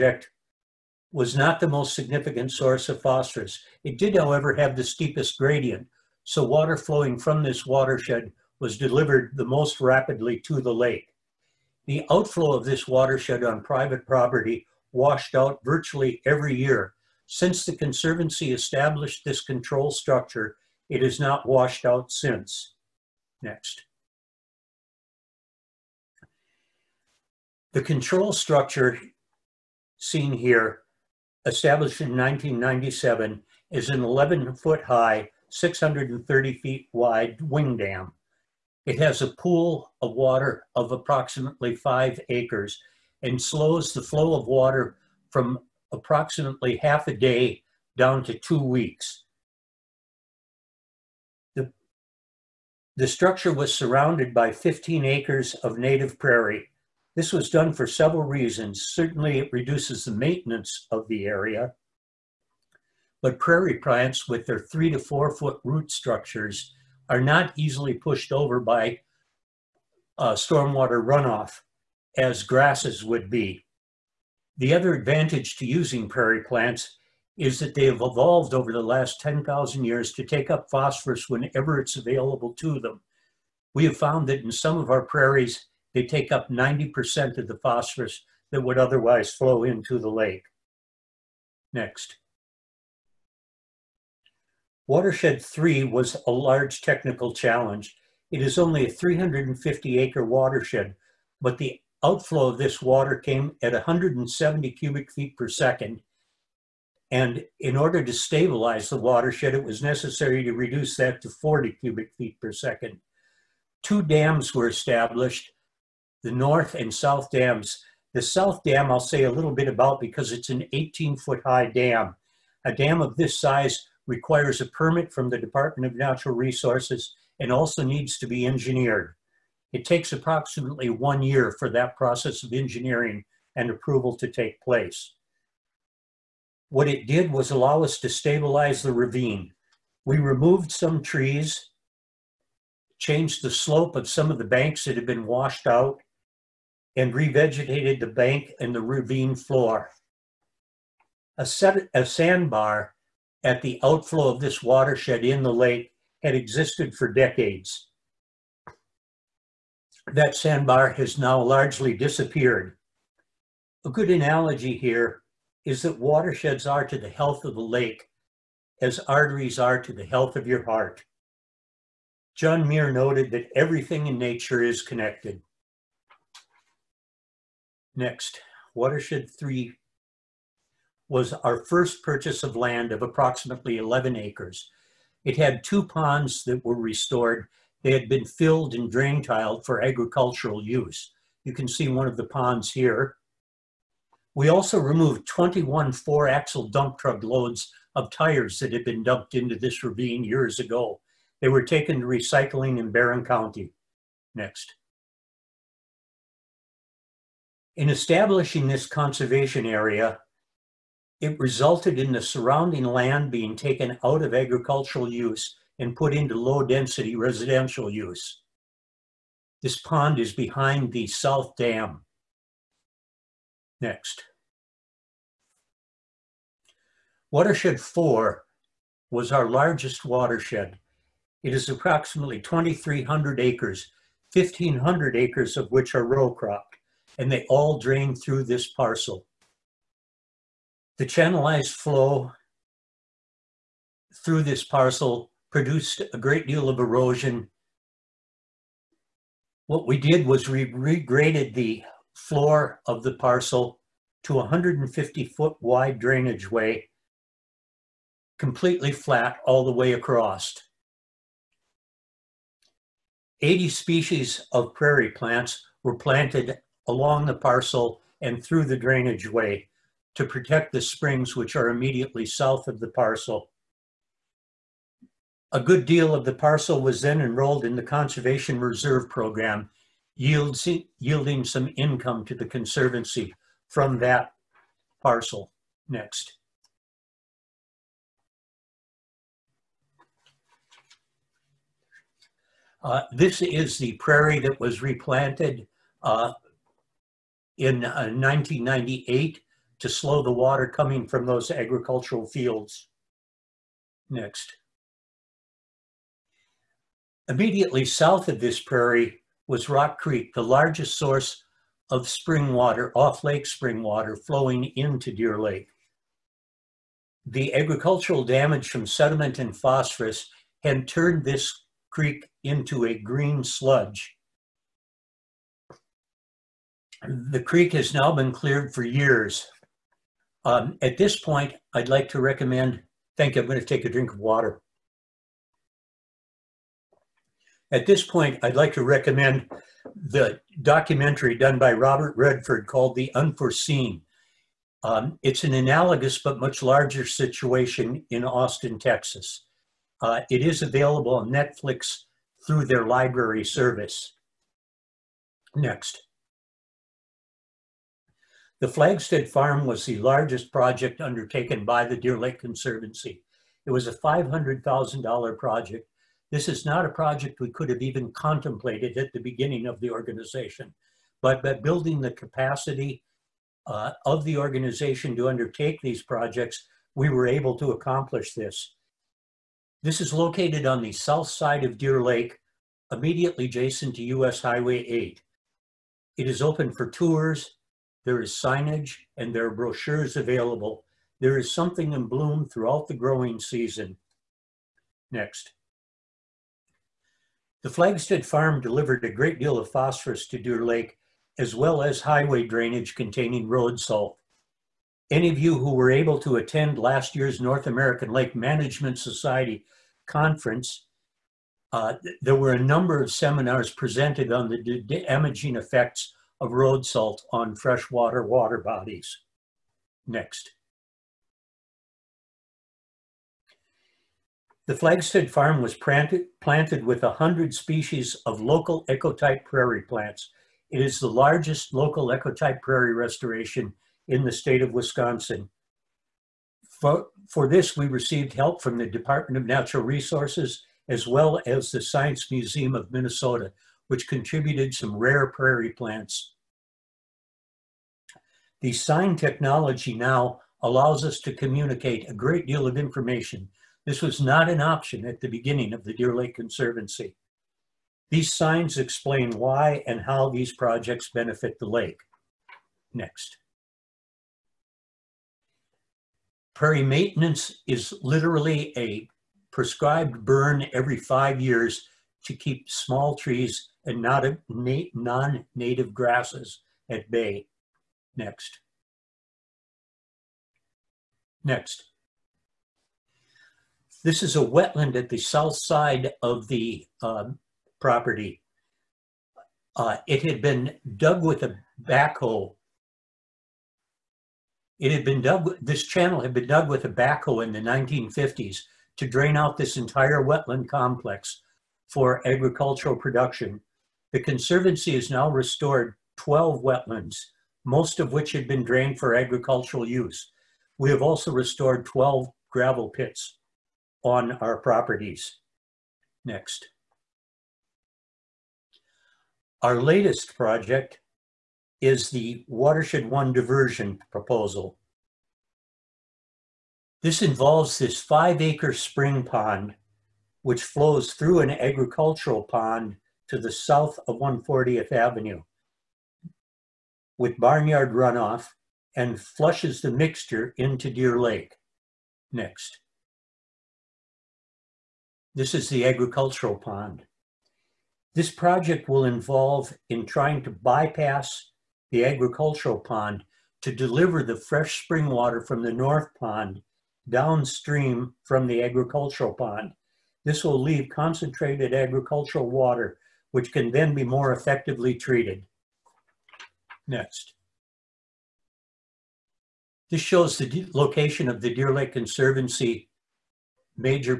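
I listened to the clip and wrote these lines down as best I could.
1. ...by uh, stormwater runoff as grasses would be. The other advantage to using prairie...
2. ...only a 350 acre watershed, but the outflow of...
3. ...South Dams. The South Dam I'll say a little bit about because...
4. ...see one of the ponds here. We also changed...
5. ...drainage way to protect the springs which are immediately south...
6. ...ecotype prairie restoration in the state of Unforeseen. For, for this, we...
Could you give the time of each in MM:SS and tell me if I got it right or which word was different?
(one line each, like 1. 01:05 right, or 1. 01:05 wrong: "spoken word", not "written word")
1. 01:08 right
2. 01:38 right
3. 01:56 right
4. 03:11 wrong: "removed", not "changed"
5. 04:28 right
6. 07:12 wrong: "Wisconsin", not "Unforeseen".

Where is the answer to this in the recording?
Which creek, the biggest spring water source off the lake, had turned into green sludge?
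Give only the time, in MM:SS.
05:09.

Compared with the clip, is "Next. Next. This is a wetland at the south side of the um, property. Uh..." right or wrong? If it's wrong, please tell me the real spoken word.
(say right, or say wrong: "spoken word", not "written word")
right.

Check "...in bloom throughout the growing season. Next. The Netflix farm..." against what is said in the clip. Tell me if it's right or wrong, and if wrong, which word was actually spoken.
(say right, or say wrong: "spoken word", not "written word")
wrong: "Flagstead", not "Netflix".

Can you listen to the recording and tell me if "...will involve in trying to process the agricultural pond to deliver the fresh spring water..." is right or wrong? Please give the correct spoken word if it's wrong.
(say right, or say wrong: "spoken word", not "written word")
wrong: "bypass", not "process".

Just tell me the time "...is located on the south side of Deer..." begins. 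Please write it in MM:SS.
06:19.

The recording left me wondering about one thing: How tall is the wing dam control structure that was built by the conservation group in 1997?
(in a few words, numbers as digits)
11 feet.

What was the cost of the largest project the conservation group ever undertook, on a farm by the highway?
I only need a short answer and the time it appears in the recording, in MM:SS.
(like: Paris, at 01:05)
$500,000, at 06:03.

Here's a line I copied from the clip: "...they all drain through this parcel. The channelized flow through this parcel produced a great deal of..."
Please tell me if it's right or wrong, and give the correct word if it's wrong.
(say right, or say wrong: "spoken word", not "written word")
right.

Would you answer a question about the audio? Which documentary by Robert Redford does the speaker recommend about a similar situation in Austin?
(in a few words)
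The Unforeseen.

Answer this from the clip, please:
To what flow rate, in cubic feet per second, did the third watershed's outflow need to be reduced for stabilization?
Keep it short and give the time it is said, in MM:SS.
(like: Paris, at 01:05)
40 cubic feet per second, at 01:51.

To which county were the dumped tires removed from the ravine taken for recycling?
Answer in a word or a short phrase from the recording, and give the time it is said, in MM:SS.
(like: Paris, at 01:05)
Barron County, at 03:22.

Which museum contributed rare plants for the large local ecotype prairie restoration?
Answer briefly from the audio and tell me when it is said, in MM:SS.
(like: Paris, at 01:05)
Science Museum of Minnesota, at 07:21.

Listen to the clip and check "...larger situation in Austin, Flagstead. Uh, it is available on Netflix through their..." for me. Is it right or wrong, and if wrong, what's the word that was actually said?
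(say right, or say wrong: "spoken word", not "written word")
wrong: "Texas", not "Flagstead".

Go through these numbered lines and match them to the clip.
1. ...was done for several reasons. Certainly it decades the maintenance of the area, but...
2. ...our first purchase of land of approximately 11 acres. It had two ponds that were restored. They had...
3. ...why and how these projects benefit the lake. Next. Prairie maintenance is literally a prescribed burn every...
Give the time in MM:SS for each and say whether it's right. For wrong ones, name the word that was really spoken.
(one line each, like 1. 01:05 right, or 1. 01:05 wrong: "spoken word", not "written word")
1. 00:57 wrong: "reduces", not "decades"
2. 03:01 right
3. 07:39 right.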